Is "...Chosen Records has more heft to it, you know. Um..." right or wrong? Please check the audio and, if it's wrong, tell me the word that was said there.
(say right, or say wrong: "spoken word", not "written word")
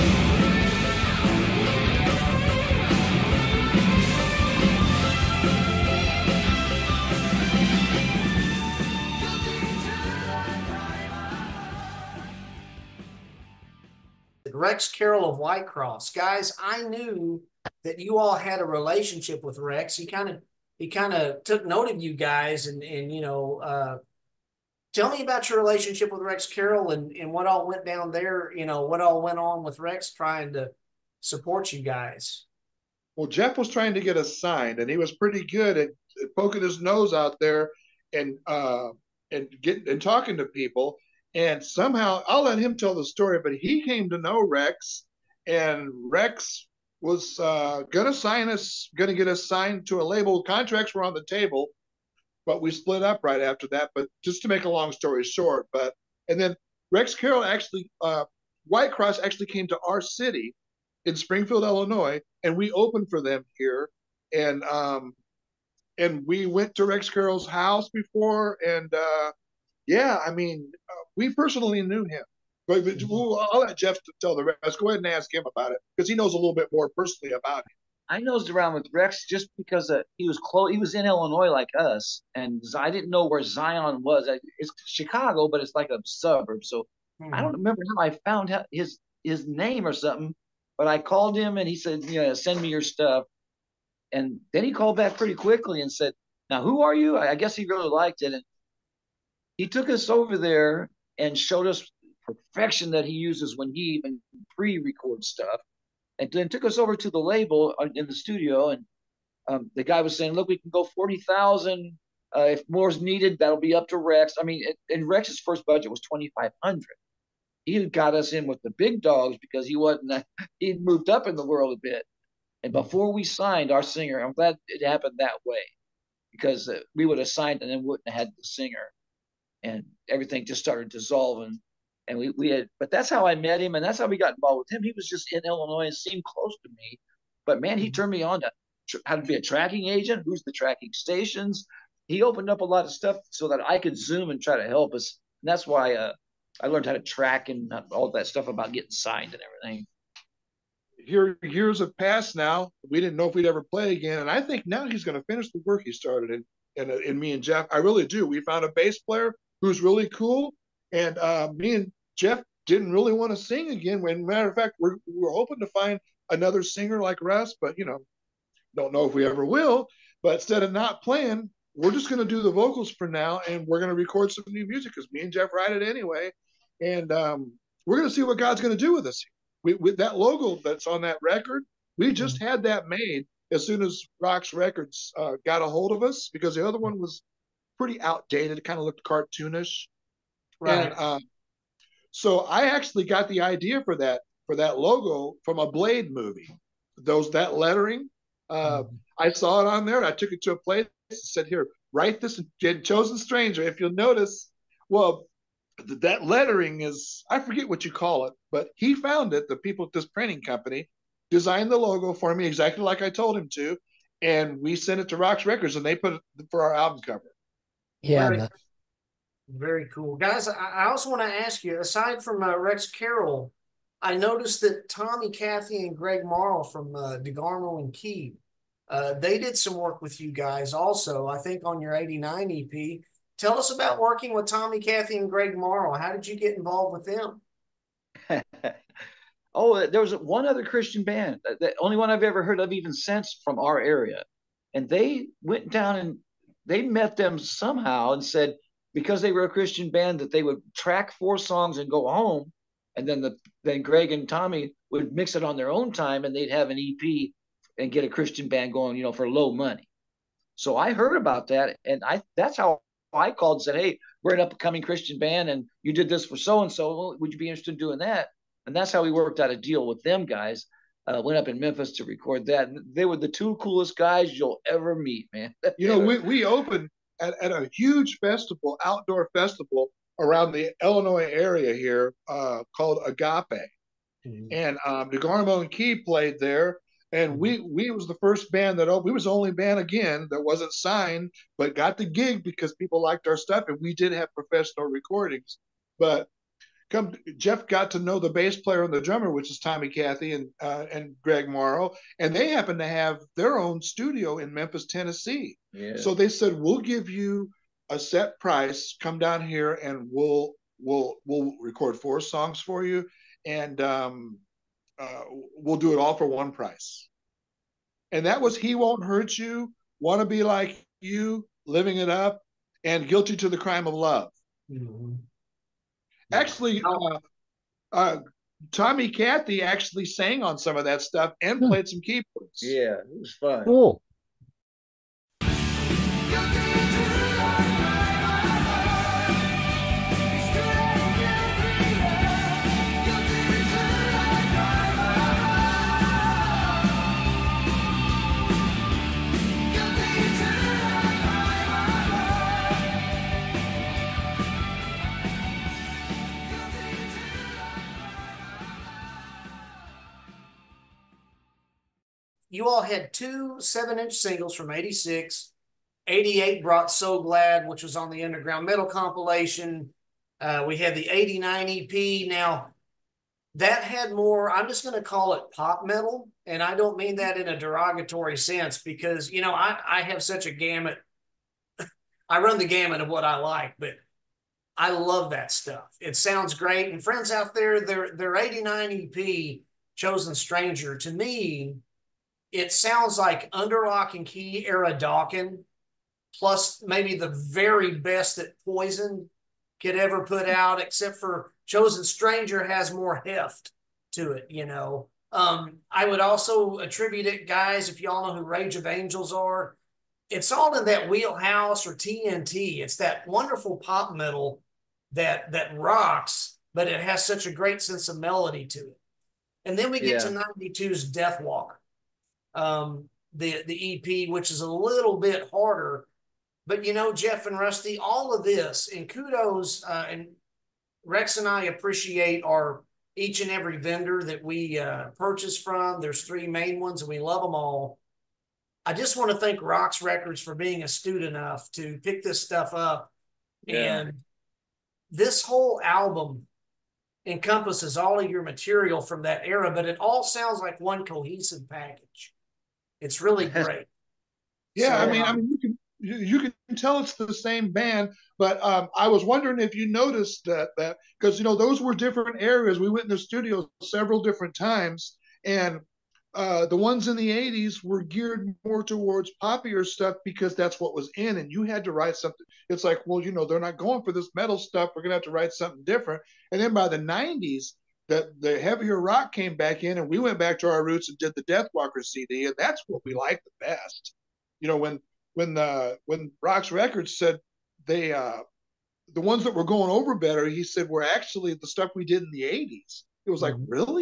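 wrong: "Stranger", not "Records".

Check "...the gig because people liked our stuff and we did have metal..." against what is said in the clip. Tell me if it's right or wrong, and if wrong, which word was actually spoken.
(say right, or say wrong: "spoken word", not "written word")
wrong: "professional", not "metal".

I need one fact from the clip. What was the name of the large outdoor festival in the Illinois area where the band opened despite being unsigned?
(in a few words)
Agape.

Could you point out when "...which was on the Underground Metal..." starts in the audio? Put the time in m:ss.
6:07.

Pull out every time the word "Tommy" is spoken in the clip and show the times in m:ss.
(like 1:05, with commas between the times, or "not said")
3:44, 3:54, 4:14, 4:59, 5:28.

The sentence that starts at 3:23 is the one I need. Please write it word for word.
If you'll notice, well, th- that lettering is I forget what you call it, but he found it.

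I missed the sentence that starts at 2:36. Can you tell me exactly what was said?
And and, and me and Jeff, I really do.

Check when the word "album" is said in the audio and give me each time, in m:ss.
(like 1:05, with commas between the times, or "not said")
3:36, 7:25.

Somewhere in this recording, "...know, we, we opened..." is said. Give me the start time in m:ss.
4:35.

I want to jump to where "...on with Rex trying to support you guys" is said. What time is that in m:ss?
0:29.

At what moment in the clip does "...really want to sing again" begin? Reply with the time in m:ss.
2:42.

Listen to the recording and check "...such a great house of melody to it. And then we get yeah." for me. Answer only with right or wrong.
wrong.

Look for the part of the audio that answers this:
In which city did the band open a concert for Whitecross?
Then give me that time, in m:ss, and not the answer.
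1:01.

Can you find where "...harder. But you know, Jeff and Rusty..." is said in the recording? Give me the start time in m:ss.
7:05.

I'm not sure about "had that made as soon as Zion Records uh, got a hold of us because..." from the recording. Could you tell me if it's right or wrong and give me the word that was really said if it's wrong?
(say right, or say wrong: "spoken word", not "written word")
wrong: "ROXX", not "Zion".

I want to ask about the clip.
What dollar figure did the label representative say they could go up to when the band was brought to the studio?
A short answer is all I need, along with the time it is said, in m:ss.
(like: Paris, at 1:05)
40000, at 1:50.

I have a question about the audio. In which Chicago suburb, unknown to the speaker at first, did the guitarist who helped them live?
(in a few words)
Zion.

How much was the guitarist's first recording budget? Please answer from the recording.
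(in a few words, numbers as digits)
2500.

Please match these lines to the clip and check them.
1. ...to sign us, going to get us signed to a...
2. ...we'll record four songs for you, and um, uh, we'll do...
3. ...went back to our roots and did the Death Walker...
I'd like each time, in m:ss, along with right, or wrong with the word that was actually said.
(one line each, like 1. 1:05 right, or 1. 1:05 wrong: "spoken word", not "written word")
1. 0:48 right
2. 5:11 right
3. 8:00 right.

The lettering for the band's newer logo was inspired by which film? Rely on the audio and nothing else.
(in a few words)
Blade.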